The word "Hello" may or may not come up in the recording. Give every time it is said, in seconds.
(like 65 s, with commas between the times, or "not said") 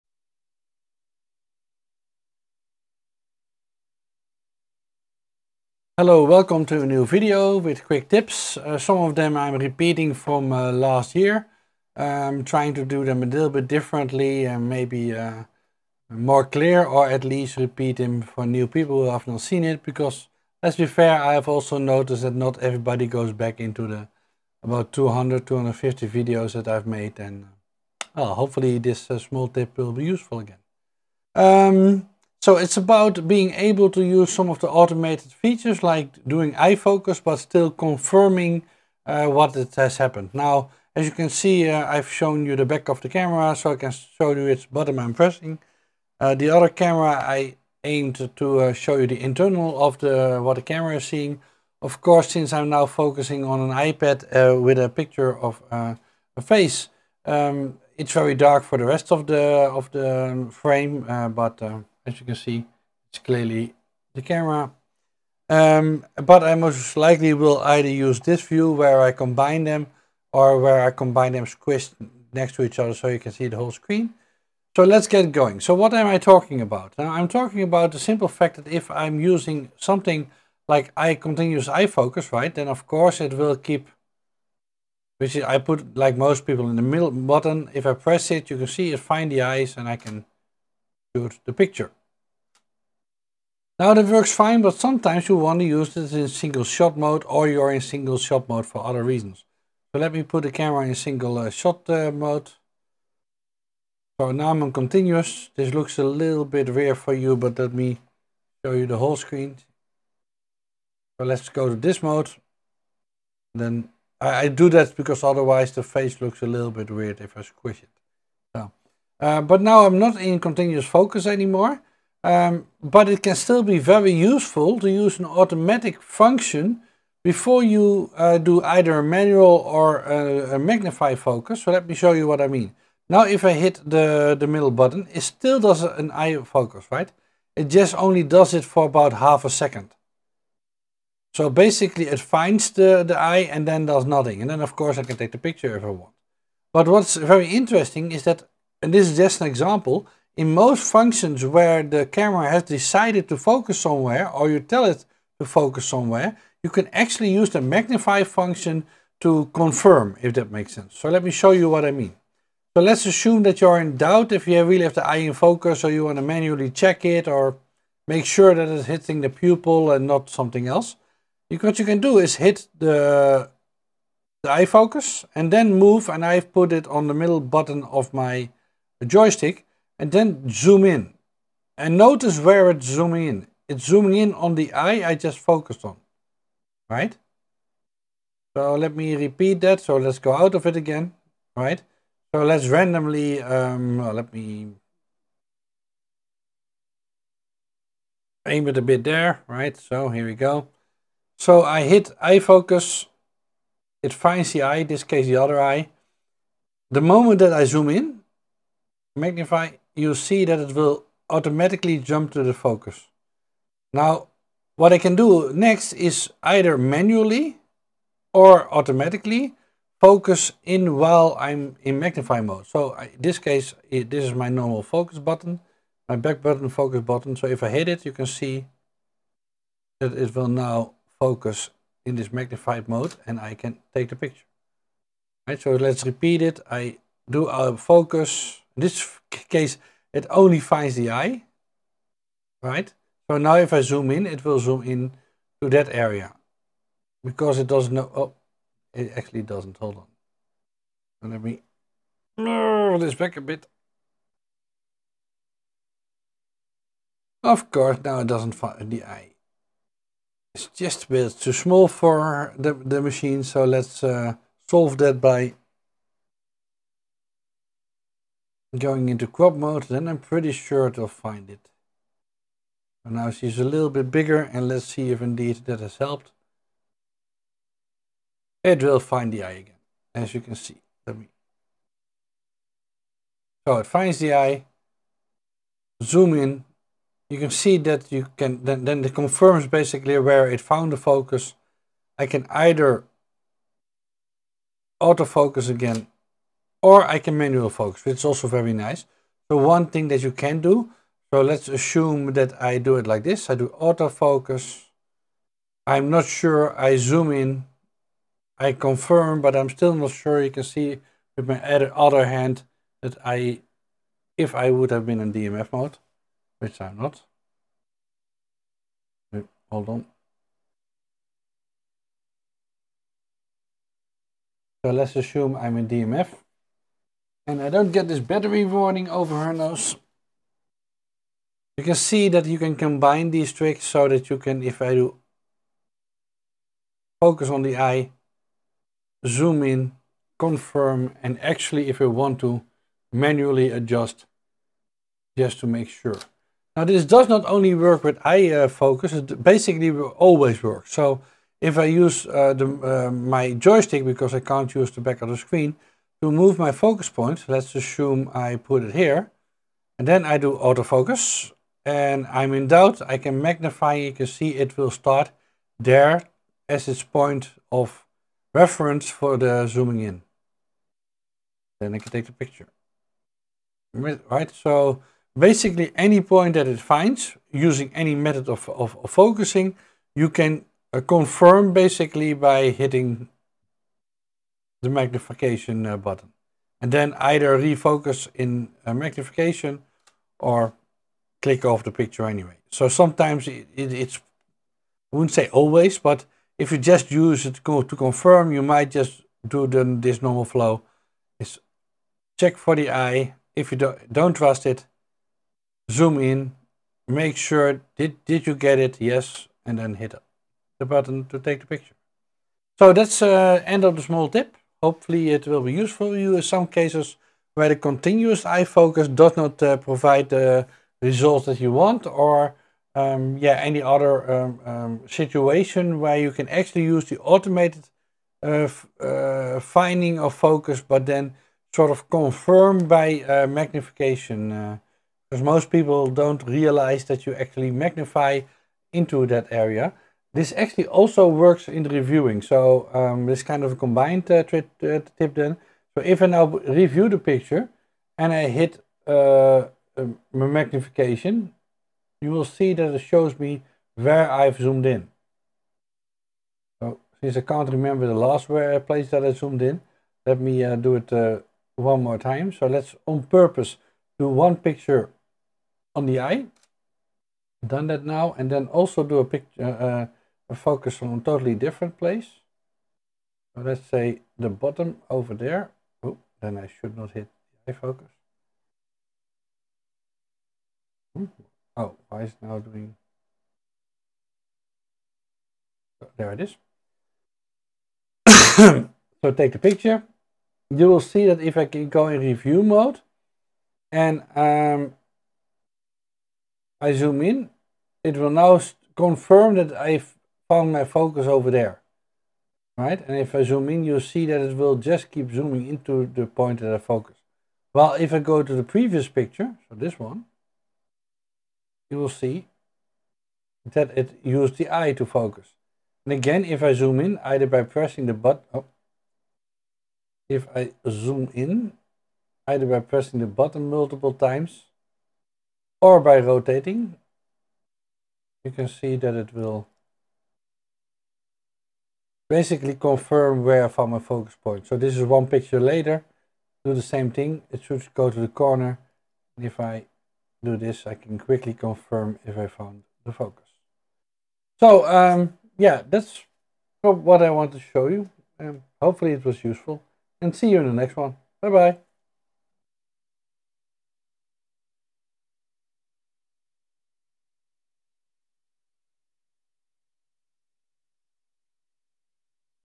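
6 s.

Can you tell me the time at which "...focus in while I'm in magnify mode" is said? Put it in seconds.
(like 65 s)
219 s.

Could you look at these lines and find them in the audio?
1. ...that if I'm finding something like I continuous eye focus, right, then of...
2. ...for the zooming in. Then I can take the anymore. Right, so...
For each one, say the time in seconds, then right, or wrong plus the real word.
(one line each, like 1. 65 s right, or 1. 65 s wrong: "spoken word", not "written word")
1. 78 s wrong: "using", not "finding"
2. 369 s wrong: "picture", not "anymore".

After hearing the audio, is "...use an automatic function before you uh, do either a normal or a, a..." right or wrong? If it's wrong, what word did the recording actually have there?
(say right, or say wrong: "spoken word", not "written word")
wrong: "manual", not "normal".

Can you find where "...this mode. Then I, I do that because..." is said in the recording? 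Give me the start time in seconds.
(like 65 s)
111 s.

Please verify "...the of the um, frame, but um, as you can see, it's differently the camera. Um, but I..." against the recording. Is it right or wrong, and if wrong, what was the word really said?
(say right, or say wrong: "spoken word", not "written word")
wrong: "clearly", not "differently".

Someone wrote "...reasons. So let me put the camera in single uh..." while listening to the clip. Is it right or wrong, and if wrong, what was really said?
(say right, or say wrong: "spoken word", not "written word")
right.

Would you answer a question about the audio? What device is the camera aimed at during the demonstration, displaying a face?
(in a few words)
iPad.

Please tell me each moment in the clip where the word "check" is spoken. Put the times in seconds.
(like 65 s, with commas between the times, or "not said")
166 s, 402 s.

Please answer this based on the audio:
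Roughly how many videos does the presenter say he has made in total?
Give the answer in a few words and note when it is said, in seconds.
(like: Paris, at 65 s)
200-250, at 24 s.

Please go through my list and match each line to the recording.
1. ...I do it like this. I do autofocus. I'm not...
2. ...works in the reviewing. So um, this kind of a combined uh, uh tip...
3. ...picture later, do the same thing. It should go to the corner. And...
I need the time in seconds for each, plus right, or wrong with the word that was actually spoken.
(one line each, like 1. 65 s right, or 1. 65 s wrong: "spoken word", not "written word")
1. 302 s right
2. 441 s right
3. 535 s right.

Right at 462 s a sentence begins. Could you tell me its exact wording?
So let's on purpose do one picture on the eye.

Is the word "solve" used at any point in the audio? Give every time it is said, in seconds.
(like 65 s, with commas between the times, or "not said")
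264 s.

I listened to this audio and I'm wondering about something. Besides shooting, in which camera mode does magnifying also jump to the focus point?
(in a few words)
Review mode.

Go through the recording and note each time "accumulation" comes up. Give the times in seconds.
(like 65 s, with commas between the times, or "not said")
not said.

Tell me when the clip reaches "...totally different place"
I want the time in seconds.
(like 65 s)
471 s.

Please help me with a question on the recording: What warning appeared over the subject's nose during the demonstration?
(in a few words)
Battery warning.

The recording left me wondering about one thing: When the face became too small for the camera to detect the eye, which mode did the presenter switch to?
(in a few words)
Crop mode.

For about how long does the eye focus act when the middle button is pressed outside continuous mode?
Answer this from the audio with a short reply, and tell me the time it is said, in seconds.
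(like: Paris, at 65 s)
Half a second, at 139 s.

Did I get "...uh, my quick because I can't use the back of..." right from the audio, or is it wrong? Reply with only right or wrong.
wrong.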